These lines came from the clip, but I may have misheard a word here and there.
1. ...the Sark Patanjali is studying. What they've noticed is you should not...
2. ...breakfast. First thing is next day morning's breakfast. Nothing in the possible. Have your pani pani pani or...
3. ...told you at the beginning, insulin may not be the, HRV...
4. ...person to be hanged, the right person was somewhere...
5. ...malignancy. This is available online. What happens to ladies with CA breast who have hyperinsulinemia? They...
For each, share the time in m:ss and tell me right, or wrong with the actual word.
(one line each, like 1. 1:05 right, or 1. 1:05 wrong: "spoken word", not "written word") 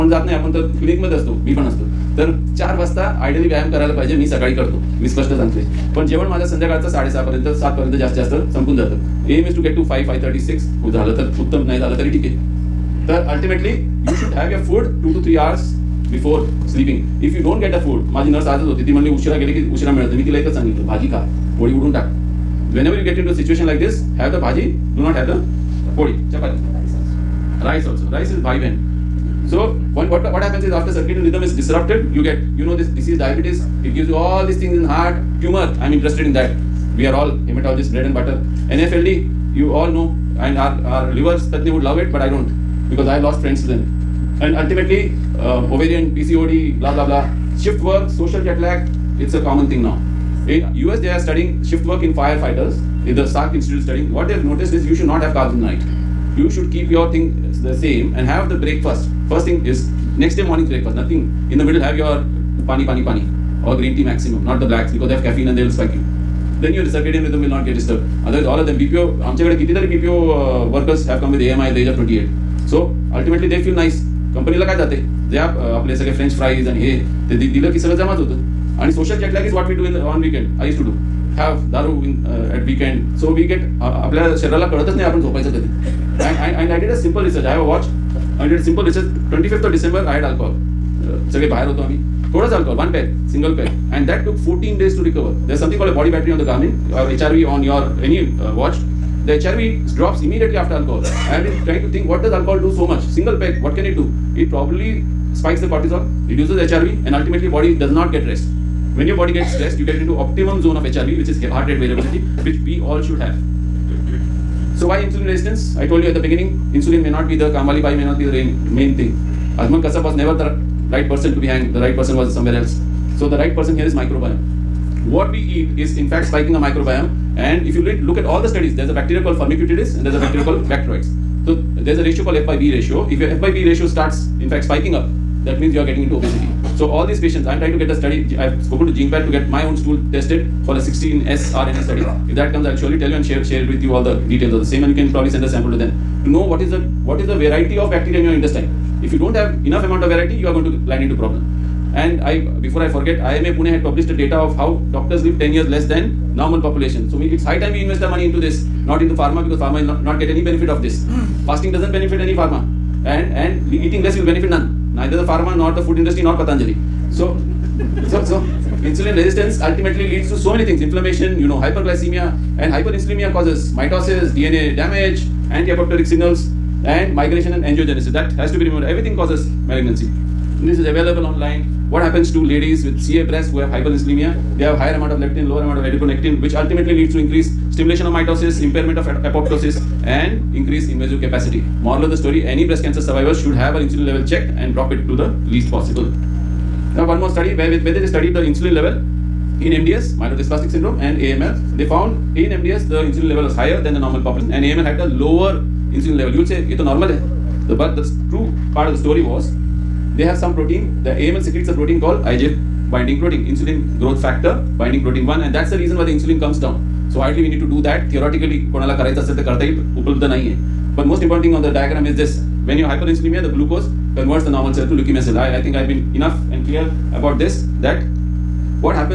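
1. 0:53 wrong: "Institute", not "Patanjali"
2. 0:58 wrong: "middle", not "possible"
3. 1:55 wrong: "Kamali", not "HRV"
4. 2:01 right
5. 2:59 right.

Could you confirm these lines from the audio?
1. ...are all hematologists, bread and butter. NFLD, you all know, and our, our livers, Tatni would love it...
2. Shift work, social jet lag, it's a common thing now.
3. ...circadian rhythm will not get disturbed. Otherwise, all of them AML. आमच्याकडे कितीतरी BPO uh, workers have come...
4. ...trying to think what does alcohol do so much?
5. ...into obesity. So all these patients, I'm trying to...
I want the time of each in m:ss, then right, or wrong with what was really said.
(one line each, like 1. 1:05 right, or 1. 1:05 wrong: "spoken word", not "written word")
1. 0:37 right
2. 0:47 right
3. 1:06 wrong: "BPO", not "AML"
4. 1:41 right
5. 2:16 right.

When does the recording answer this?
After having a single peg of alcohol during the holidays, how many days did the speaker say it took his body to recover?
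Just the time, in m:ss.
1:34.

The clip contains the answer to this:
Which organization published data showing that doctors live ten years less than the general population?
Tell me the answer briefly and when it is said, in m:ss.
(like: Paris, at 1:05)
IMA Pune, at 2:33.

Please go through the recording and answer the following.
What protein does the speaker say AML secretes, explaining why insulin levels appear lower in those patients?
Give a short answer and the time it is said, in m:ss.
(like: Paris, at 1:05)
IGF binding protein 1, at 3:32.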